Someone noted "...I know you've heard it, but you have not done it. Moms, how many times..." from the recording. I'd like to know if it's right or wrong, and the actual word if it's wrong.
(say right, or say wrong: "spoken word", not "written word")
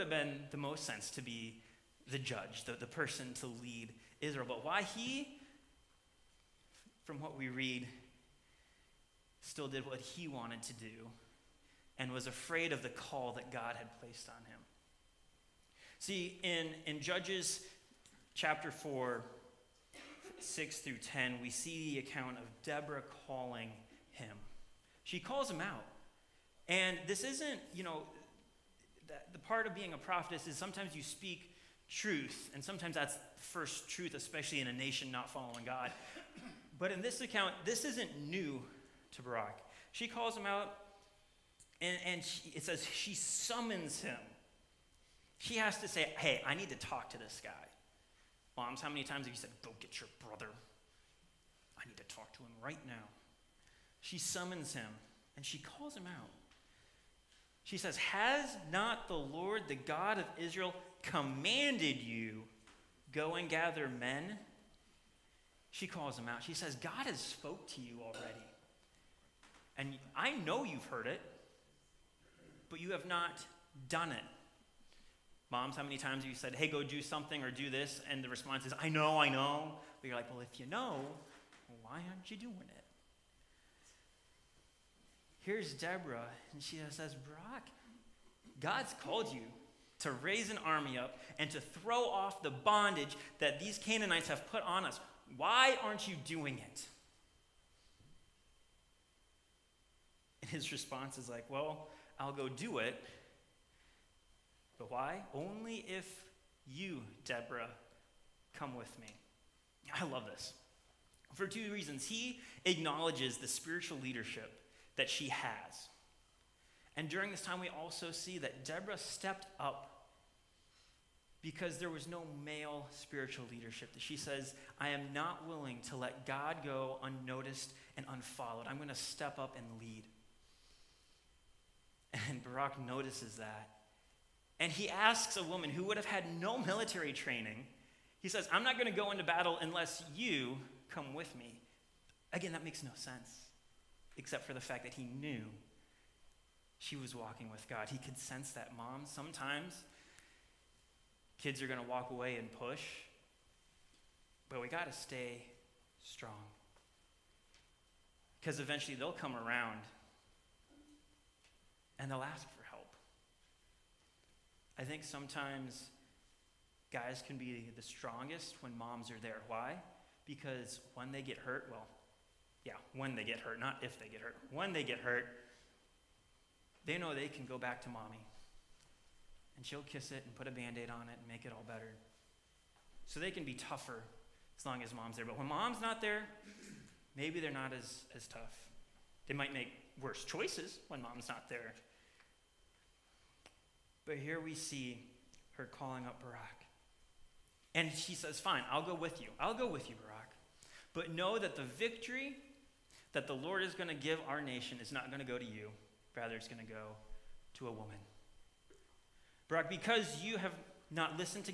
right.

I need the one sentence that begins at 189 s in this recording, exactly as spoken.
They might make worse choices when mom's not there.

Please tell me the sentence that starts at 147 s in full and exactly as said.
He could sense that, Mom, sometimes kids are going to walk away and push, but we got to stay strong.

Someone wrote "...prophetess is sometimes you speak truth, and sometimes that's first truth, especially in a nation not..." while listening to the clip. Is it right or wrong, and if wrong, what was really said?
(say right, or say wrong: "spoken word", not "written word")
right.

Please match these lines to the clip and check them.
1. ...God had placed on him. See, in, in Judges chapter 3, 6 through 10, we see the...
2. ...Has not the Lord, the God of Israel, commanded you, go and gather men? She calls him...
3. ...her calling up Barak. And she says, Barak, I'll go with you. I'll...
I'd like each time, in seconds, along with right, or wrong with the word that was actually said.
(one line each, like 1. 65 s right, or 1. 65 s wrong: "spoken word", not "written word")
1. 13 s wrong: "4", not "3"
2. 57 s right
3. 195 s wrong: "Fine", not "Barak".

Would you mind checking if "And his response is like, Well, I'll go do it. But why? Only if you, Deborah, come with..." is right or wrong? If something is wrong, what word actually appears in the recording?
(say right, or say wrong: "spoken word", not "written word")
right.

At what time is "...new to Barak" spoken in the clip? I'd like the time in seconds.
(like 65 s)
38 s.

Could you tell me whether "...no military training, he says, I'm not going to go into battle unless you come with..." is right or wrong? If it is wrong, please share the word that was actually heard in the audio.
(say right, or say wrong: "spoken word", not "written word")
right.